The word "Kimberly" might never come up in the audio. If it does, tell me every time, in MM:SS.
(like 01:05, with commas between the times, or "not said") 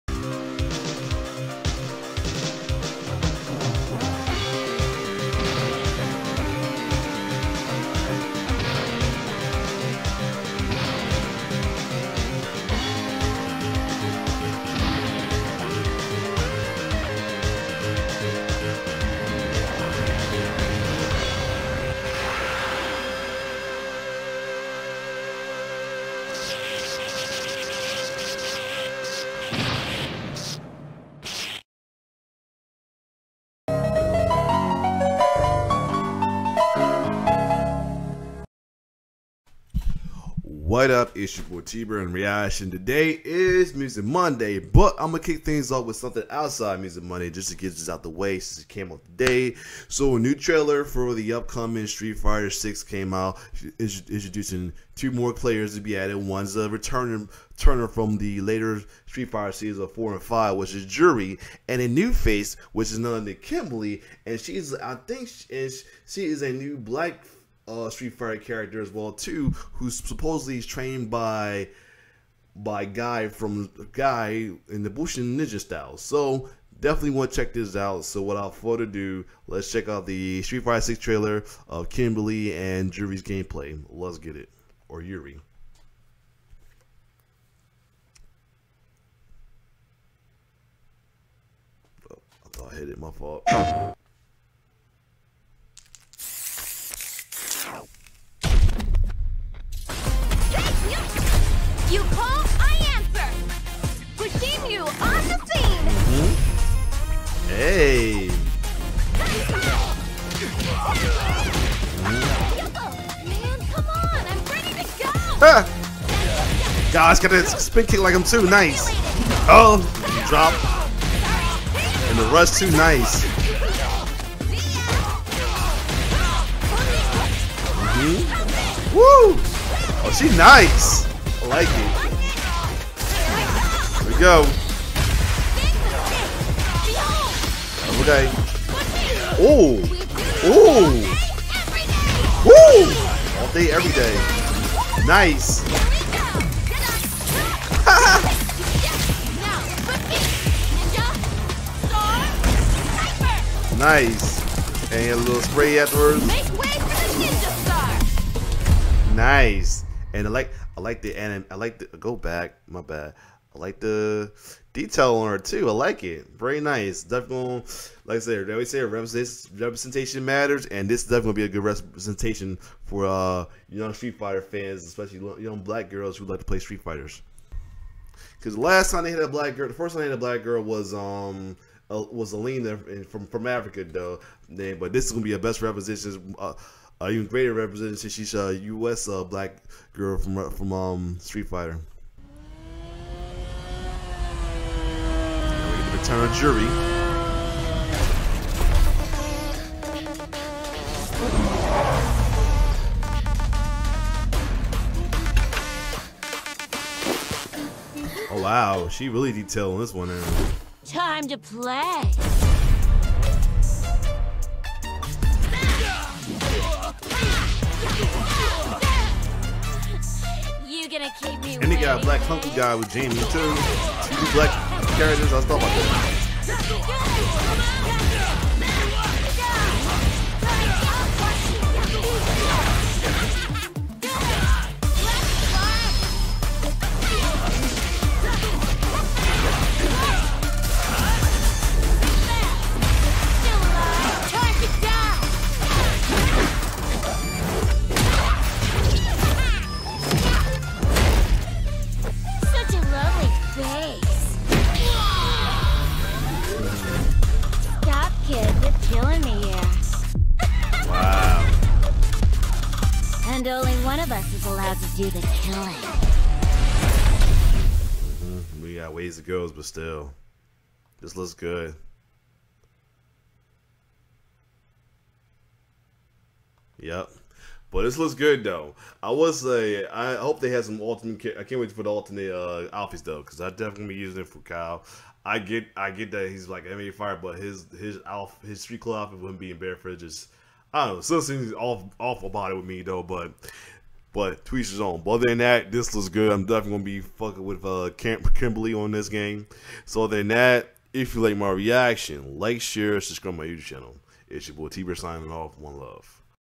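01:03, 01:21, 04:57.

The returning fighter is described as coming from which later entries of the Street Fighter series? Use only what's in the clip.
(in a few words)
4 and 5.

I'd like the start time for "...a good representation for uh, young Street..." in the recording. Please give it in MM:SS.
02:51.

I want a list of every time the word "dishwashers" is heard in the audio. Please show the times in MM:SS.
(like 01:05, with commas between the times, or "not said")
not said.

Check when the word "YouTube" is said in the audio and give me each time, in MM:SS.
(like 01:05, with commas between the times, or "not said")
05:03.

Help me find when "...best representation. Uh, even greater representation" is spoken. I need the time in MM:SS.
03:05.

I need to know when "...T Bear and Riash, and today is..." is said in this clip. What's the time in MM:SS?
00:41.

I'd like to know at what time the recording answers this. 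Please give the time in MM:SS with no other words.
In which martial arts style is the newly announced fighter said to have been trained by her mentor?
01:14.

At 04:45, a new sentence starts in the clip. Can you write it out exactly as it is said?
I get, I get that he's like MMA fire, but his his Alf his street club outfit wouldn't be in bare fridges.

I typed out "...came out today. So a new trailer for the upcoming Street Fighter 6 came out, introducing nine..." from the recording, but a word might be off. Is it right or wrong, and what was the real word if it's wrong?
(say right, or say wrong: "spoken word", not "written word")
wrong: "two", not "nine".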